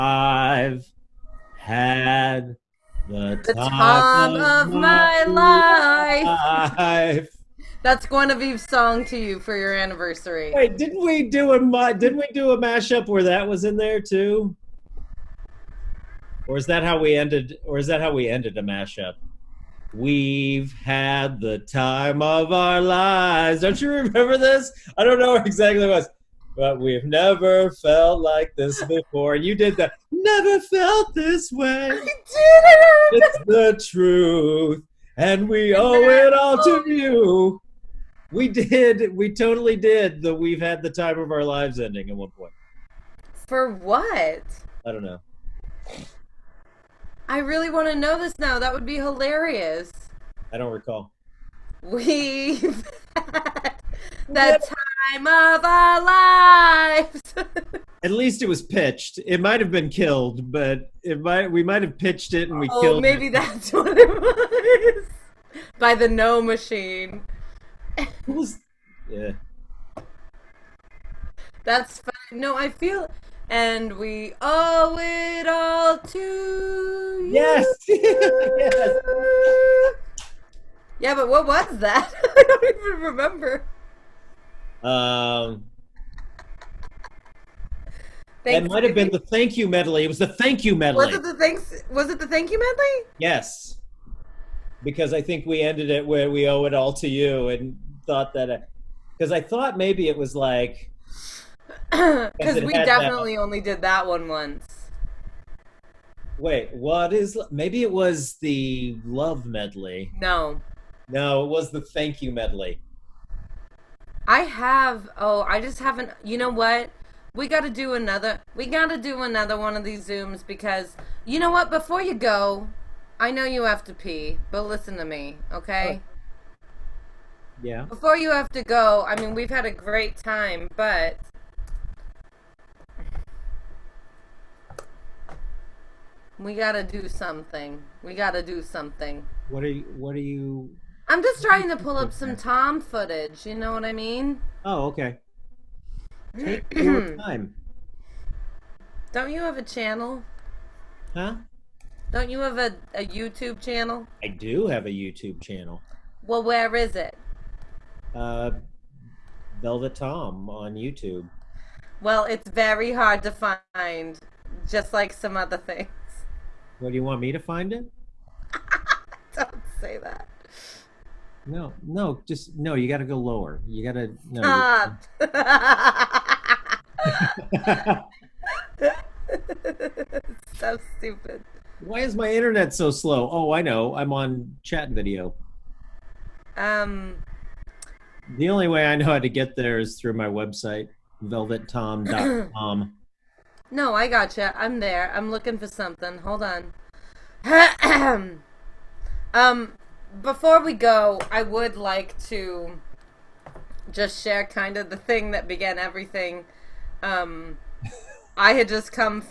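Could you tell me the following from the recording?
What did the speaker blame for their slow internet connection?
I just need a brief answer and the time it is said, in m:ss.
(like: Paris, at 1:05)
Chat video, at 3:04.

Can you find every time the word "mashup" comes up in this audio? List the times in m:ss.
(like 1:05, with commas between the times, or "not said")
0:12, 0:18.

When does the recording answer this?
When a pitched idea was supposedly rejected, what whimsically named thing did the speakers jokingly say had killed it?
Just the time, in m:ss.
1:05.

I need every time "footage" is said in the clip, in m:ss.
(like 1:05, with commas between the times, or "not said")
2:22.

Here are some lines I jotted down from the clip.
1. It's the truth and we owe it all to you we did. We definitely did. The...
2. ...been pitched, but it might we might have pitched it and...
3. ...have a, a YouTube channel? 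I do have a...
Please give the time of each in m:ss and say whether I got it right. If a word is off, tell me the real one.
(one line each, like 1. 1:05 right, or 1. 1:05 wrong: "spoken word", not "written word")
1. 0:33 wrong: "totally", not "definitely"
2. 0:59 wrong: "killed", not "pitched"
3. 2:32 right.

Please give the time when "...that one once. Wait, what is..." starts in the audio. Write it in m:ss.
1:43.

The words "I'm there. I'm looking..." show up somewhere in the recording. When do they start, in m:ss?
3:14.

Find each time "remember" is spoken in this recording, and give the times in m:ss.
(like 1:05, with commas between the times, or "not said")
0:23, 1:23.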